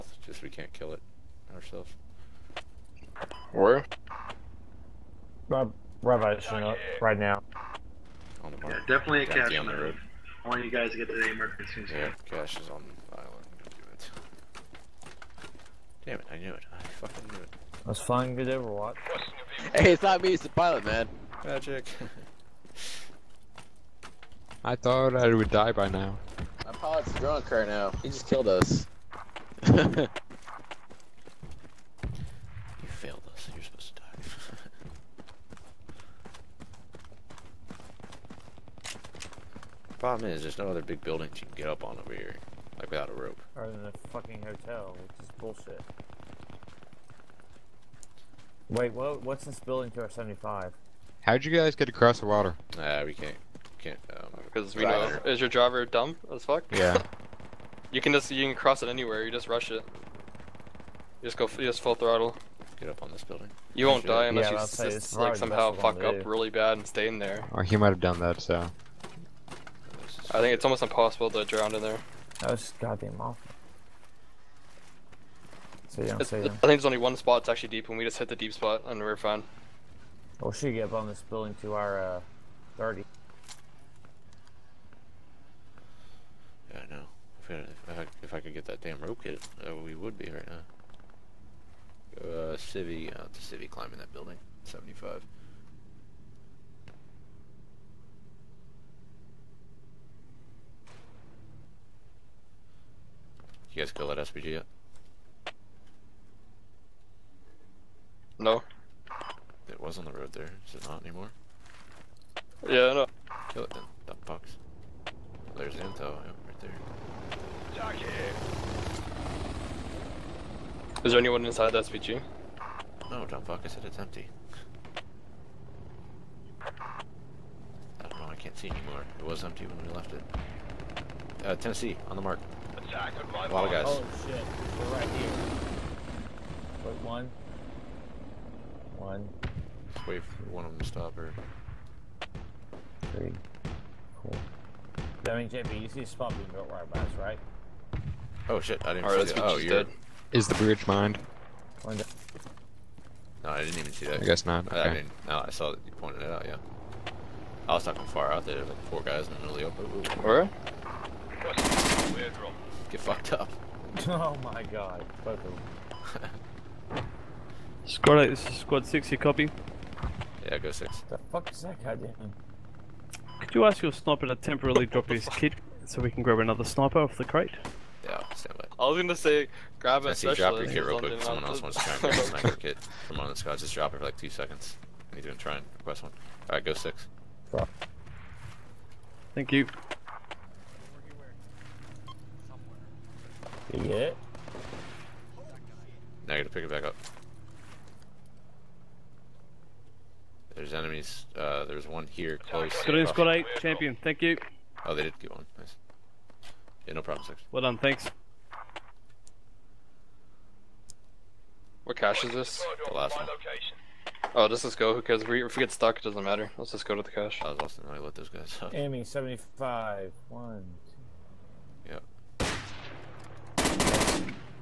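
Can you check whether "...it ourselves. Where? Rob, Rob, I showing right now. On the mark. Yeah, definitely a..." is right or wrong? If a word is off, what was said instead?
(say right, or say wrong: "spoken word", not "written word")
right.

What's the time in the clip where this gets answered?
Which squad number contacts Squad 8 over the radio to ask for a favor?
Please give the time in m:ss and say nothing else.
2:48.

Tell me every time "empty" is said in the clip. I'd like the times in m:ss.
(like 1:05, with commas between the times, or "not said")
2:03, 2:09.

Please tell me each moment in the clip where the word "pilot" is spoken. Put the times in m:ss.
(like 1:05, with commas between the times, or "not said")
0:20, 0:26.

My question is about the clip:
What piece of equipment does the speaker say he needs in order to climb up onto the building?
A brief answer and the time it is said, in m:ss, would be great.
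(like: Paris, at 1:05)
Rope kit, at 1:29.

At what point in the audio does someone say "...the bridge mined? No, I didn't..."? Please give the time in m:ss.
2:30.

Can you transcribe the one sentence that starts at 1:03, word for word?
You won't die unless yeah, you just, like somehow fuck up really bad and stay in there.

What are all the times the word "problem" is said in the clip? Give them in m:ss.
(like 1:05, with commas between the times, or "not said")
0:39, 3:27.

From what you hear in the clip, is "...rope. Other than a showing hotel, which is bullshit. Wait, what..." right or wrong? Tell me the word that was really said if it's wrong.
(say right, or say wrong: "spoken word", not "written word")
wrong: "fucking", not "showing".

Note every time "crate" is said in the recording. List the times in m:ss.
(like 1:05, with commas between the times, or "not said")
2:57.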